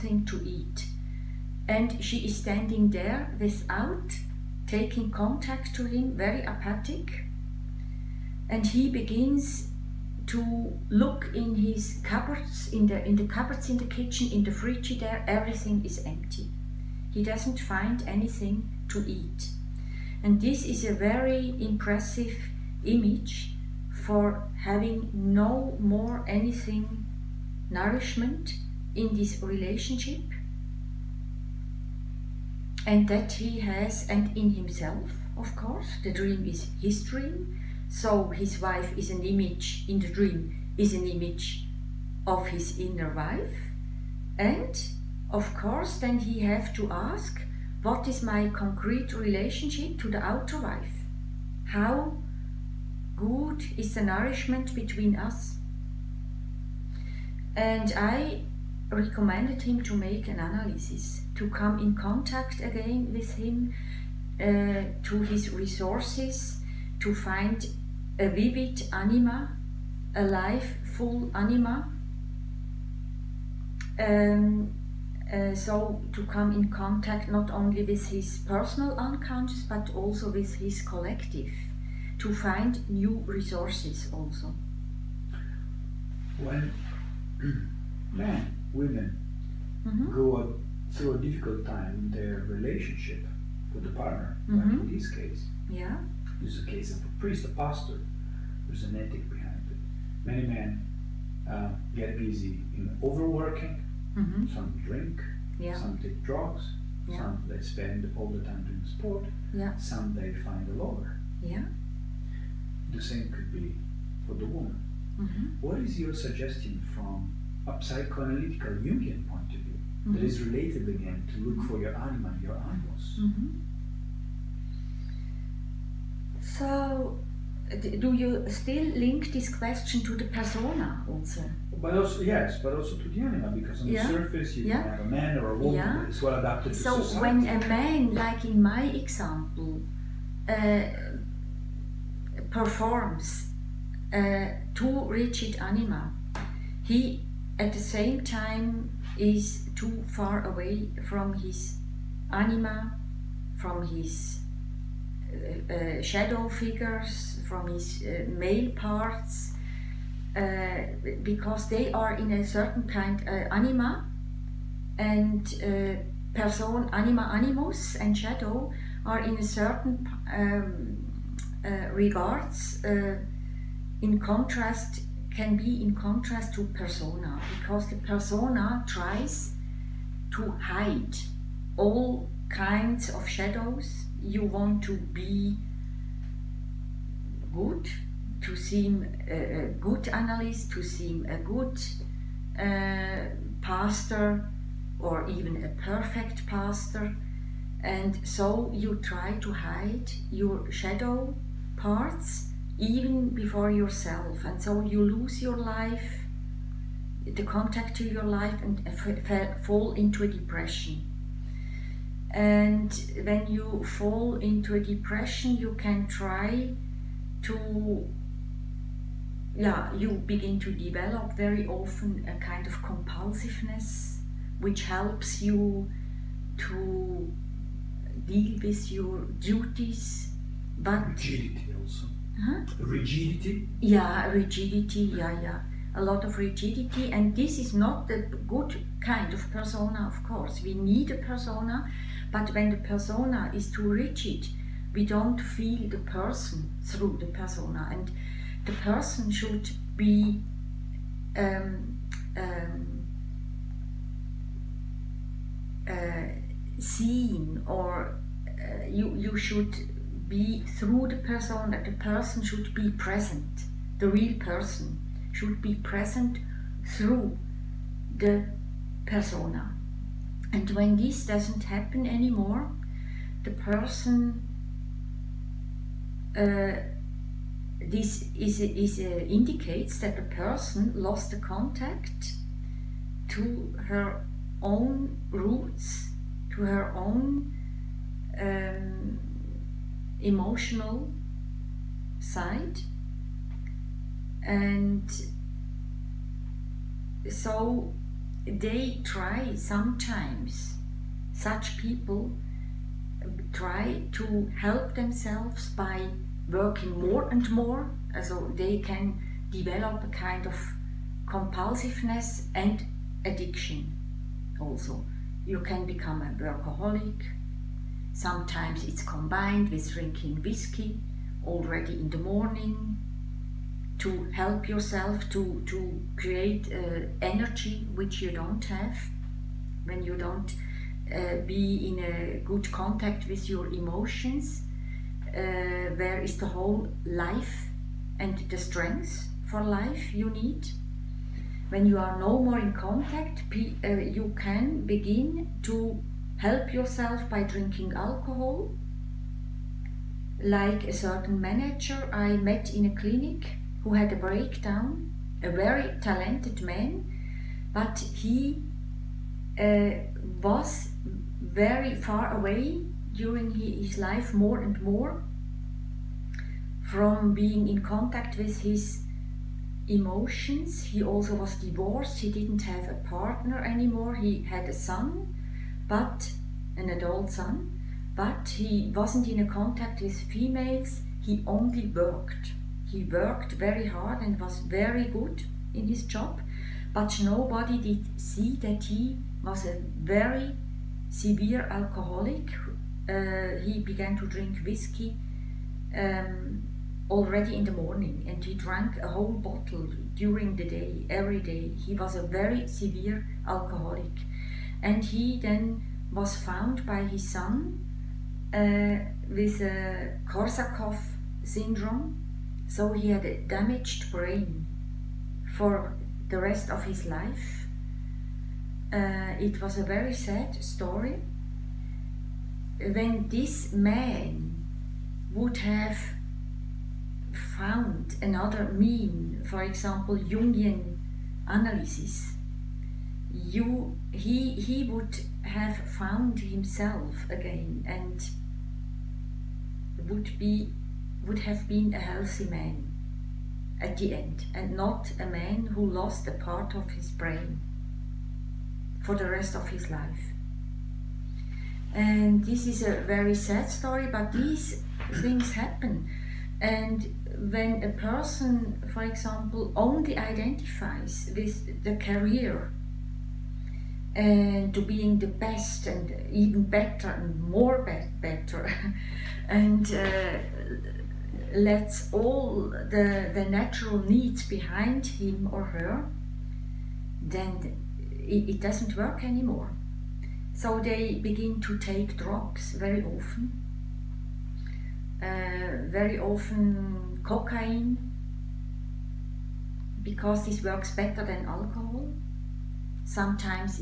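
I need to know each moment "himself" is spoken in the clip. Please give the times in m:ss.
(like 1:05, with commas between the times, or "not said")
0:34, 7:16.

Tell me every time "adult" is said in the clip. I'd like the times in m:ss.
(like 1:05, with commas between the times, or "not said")
6:16.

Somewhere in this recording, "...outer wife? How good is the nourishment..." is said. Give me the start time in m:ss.
0:50.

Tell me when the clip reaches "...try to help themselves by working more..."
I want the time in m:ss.
5:03.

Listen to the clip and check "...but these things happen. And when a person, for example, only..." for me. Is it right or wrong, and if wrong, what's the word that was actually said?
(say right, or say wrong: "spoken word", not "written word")
right.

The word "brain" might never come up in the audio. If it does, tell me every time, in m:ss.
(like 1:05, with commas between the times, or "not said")
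6:54, 7:27.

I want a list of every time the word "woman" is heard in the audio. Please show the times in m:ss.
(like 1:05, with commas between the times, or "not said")
1:54, 2:15.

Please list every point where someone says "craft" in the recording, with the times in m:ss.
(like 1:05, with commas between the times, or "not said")
not said.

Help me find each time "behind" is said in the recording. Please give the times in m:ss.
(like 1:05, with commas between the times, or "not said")
1:39, 7:54.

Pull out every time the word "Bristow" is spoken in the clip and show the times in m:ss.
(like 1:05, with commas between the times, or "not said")
not said.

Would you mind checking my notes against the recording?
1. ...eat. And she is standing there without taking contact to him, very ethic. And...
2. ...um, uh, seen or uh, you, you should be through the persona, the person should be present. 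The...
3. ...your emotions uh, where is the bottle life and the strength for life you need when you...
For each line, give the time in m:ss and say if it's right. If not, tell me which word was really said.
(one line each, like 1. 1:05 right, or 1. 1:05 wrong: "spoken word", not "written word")
1. 0:00 wrong: "apathic", not "ethic"
2. 4:12 right
3. 5:33 wrong: "whole", not "bottle".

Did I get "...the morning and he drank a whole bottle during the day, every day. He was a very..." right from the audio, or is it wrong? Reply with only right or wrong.
right.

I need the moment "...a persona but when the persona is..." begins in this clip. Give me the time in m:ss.
4:01.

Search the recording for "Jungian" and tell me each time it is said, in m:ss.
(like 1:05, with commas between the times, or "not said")
1:58, 7:10.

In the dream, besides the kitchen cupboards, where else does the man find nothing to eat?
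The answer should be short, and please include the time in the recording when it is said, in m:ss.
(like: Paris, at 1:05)
The fridge, at 0:14.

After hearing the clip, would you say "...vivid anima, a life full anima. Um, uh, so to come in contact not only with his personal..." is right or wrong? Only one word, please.
right.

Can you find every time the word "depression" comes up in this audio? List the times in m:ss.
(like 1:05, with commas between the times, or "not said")
3:30, 3:34.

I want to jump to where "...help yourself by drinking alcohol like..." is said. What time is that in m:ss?
5:46.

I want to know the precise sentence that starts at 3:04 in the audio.
You want to be good, to seem a, good analyst, to seem a good uh, pastor or even a perfect pastor.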